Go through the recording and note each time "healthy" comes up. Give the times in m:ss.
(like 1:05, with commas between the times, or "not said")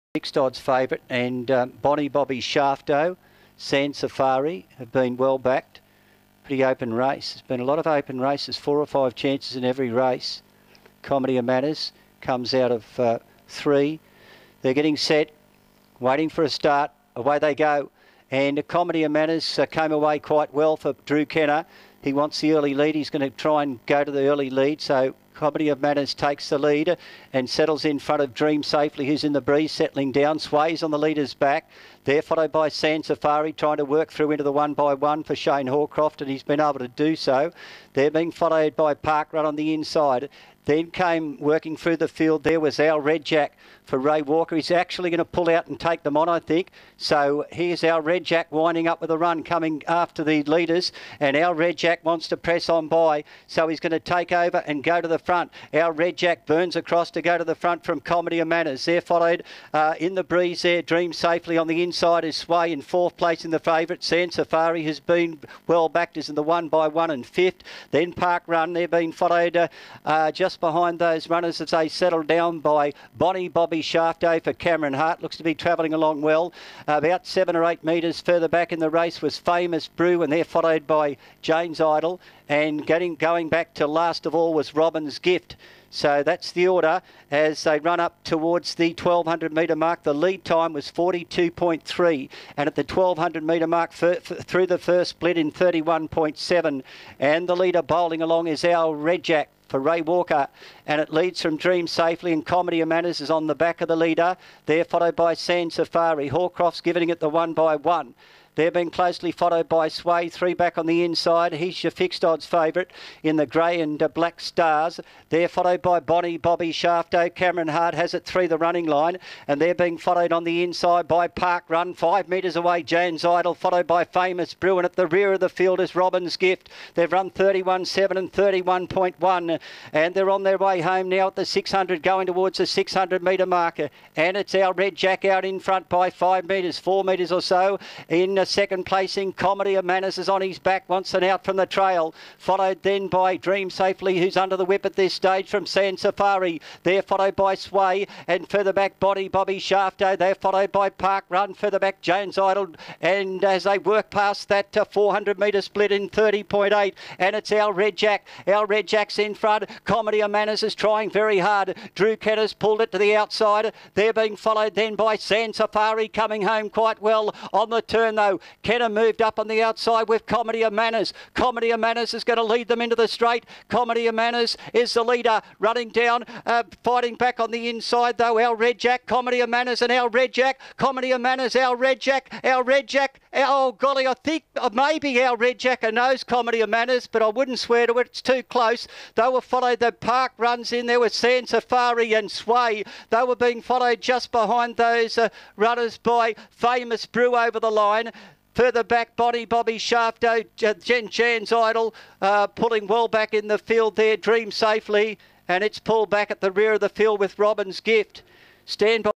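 not said.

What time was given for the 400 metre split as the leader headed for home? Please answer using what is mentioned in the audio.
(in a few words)
30.8.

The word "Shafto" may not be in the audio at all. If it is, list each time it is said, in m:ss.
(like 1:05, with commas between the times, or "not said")
0:02, 1:13, 1:56, 2:29, 3:19.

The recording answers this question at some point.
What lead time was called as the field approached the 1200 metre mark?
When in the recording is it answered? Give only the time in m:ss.
1:30.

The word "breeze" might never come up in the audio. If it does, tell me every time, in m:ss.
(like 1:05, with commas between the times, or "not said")
0:29, 1:00.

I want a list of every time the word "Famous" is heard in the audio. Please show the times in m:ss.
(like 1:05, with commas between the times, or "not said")
1:19, 2:04, 3:16.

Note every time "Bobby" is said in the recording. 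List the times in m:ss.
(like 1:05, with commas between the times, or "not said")
0:02, 1:13, 1:56, 2:29, 3:19.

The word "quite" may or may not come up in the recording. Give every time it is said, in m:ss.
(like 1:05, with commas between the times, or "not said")
0:20, 2:46.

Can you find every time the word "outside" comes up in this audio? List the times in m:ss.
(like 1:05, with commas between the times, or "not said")
2:43, 2:49.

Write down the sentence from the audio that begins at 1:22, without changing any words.
And getting going back to last of all was Robin's Gift.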